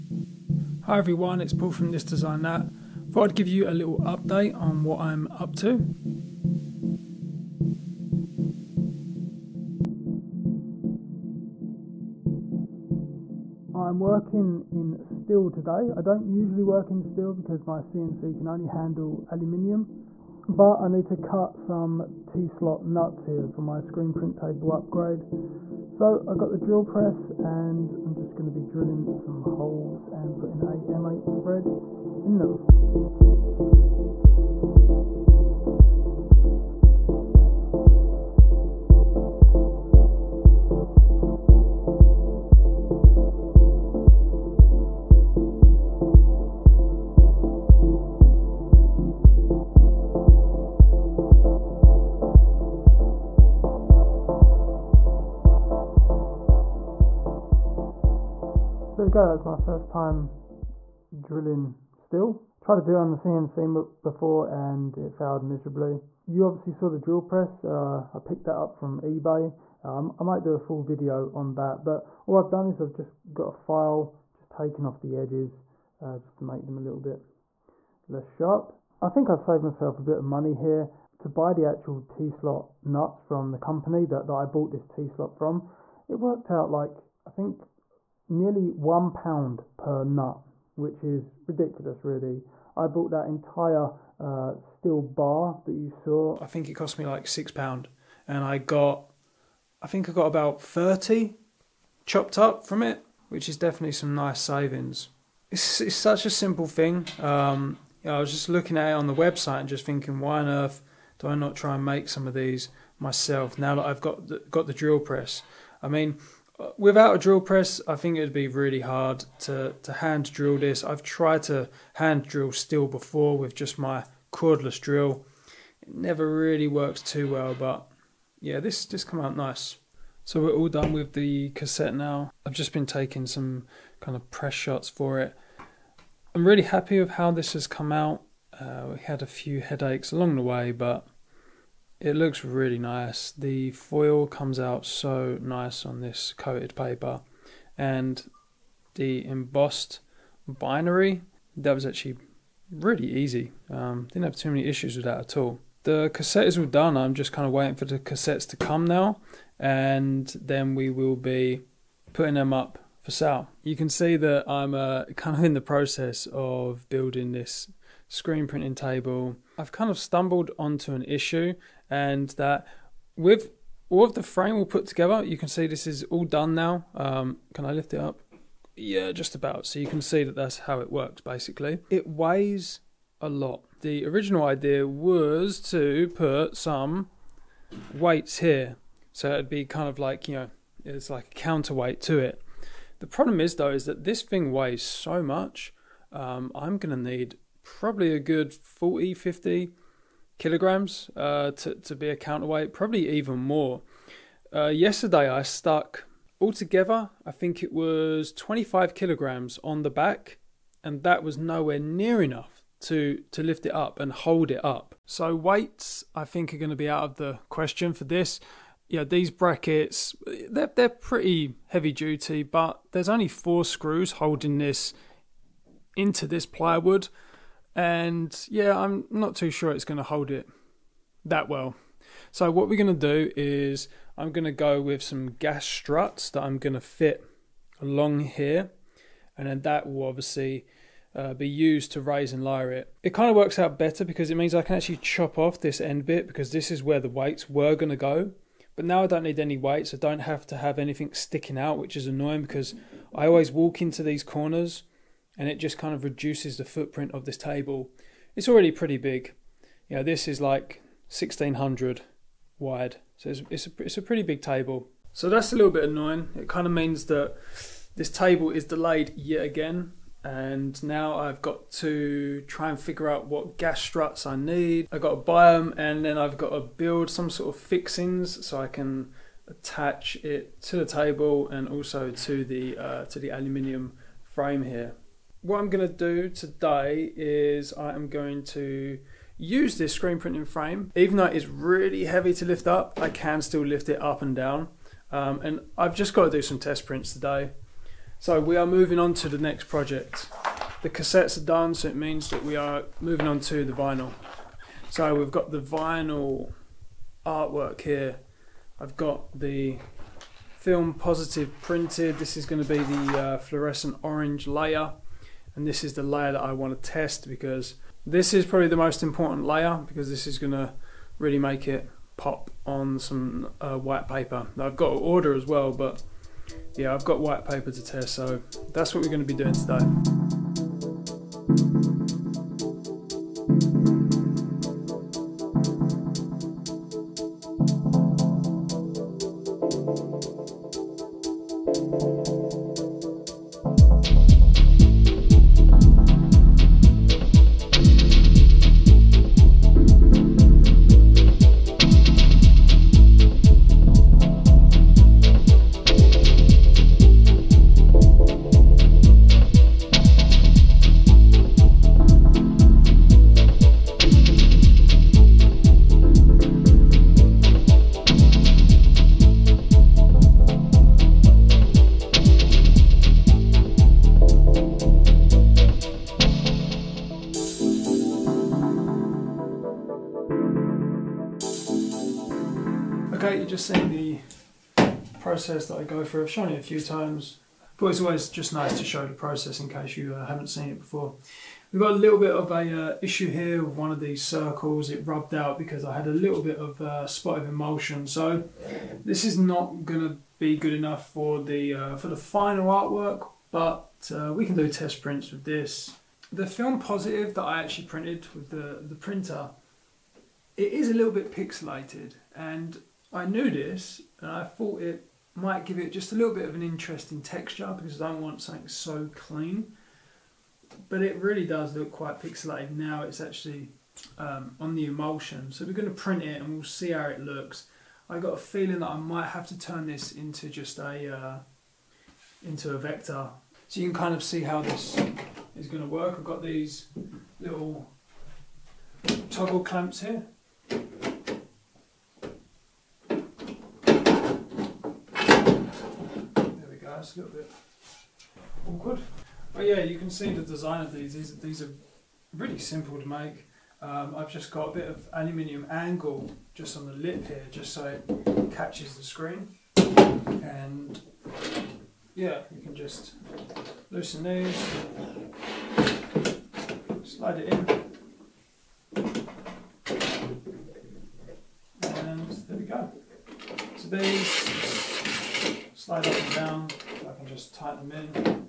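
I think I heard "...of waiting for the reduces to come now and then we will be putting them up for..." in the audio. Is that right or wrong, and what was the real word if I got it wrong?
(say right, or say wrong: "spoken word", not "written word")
wrong: "cassettes", not "reduces".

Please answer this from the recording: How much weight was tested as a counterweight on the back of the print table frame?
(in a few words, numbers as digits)
25 kilograms.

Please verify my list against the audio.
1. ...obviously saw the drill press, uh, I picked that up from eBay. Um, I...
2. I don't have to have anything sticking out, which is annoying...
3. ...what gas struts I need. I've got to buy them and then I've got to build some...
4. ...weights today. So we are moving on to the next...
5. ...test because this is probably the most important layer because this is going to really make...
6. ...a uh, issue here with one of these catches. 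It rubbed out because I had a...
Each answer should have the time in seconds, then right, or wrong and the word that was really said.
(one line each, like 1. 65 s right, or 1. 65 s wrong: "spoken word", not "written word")
1. 66 s right
2. 249 s right
3. 273 s right
4. 296 s wrong: "prints", not "weights"
5. 316 s right
6. 392 s wrong: "circles", not "catches".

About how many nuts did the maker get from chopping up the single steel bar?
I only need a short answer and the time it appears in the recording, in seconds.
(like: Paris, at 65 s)
30, at 100 s.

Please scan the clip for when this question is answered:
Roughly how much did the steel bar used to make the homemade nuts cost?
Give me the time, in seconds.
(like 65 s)
97 s.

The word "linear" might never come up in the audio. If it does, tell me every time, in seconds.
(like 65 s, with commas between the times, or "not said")
not said.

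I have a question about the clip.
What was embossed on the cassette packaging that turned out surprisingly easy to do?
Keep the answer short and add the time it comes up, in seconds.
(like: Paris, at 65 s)
binary, at 149 s.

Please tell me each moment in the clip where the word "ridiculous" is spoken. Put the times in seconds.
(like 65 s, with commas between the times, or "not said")
91 s.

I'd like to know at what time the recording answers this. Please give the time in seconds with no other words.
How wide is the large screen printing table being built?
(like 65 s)
261 s.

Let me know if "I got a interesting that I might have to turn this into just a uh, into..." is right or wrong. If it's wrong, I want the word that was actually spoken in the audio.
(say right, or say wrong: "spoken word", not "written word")
wrong: "feeling", not "interesting".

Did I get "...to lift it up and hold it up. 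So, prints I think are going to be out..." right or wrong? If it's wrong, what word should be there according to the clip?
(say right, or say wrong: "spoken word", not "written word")
wrong: "weights", not "prints".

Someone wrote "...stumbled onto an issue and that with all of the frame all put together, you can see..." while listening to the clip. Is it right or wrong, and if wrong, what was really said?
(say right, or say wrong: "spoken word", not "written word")
right.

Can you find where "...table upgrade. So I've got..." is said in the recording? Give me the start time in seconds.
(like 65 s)
24 s.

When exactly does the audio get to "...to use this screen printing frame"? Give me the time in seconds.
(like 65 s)
288 s.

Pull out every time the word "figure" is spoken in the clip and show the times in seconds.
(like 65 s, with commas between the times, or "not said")
272 s.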